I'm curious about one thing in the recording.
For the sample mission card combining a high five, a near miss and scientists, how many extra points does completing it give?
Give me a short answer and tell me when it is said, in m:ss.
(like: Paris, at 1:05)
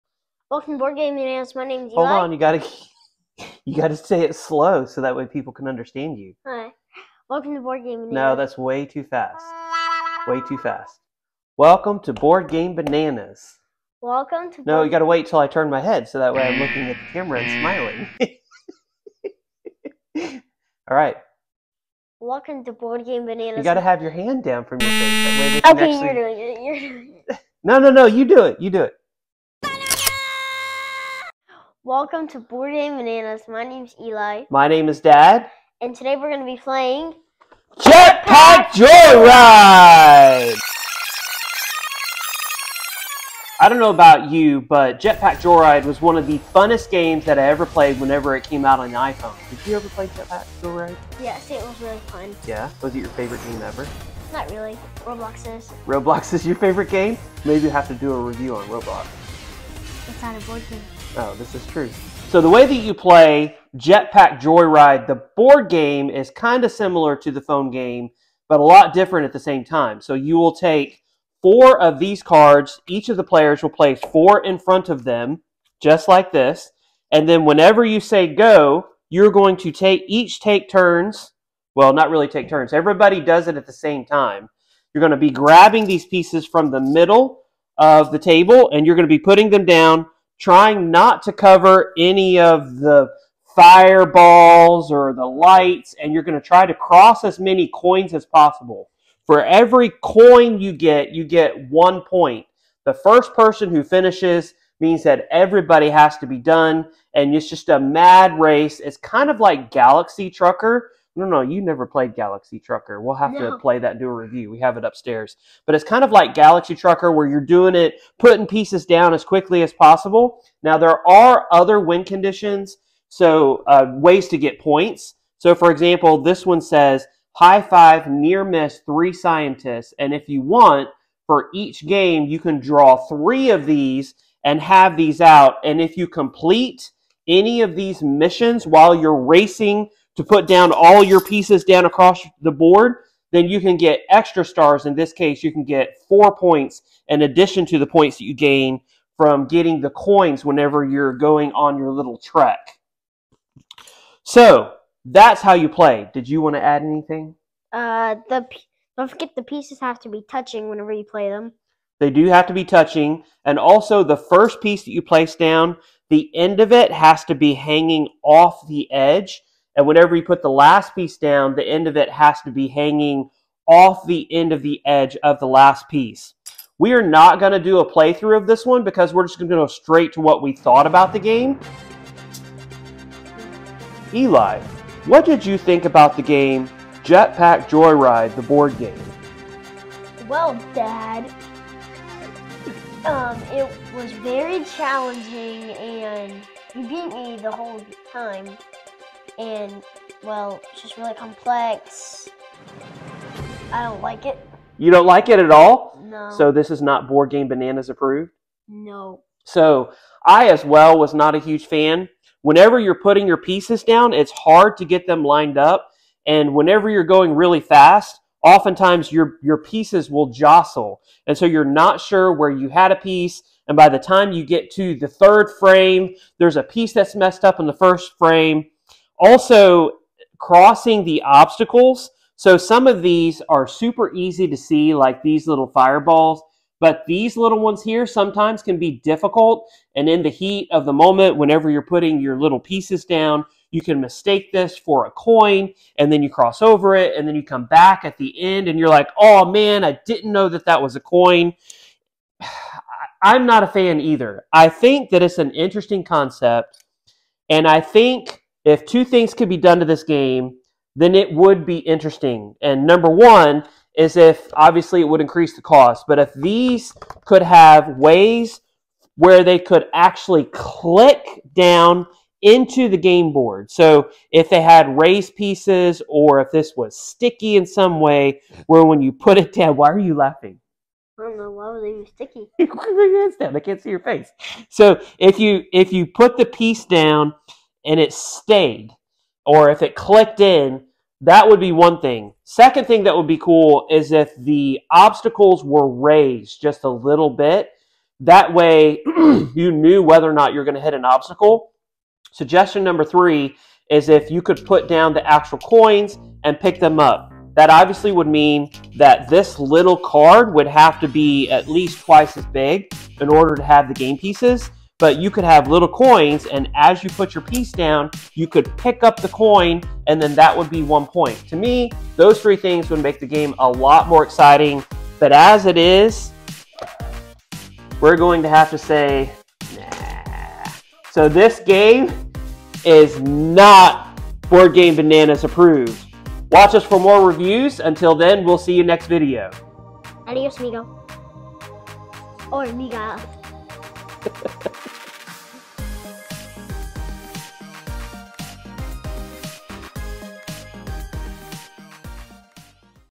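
4, at 2:26.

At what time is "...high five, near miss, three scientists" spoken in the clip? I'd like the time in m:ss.
2:07.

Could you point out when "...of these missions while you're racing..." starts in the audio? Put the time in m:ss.
2:17.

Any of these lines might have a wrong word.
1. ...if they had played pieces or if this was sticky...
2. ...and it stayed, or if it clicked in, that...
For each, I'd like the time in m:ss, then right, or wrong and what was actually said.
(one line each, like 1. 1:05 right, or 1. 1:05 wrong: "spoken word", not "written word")
1. 4:34 wrong: "raised", not "played"
2. 4:47 right.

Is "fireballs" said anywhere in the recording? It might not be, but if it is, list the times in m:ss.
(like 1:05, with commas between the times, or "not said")
1:33, 3:55.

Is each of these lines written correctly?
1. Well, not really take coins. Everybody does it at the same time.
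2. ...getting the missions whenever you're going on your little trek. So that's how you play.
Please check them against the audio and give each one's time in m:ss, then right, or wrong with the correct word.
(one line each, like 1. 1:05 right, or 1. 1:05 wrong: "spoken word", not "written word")
1. 1:21 wrong: "turns", not "coins"
2. 2:29 wrong: "coins", not "missions".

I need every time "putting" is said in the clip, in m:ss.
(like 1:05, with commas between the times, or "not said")
1:29, 1:58, 3:33, 4:01.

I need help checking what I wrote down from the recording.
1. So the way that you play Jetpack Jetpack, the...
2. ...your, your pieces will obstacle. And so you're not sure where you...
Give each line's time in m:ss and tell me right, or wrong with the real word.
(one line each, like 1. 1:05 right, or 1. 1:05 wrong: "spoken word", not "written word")
1. 1:02 wrong: "Joyride", not "Jetpack"
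2. 3:39 wrong: "jostle", not "obstacle".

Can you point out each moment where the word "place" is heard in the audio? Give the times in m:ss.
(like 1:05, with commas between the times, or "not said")
1:13, 2:45.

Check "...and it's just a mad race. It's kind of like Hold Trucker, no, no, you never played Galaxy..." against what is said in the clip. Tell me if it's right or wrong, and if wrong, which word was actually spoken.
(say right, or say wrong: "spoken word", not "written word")
wrong: "Galaxy", not "Hold".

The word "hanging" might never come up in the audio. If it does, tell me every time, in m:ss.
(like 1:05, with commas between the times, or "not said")
2:47, 2:52.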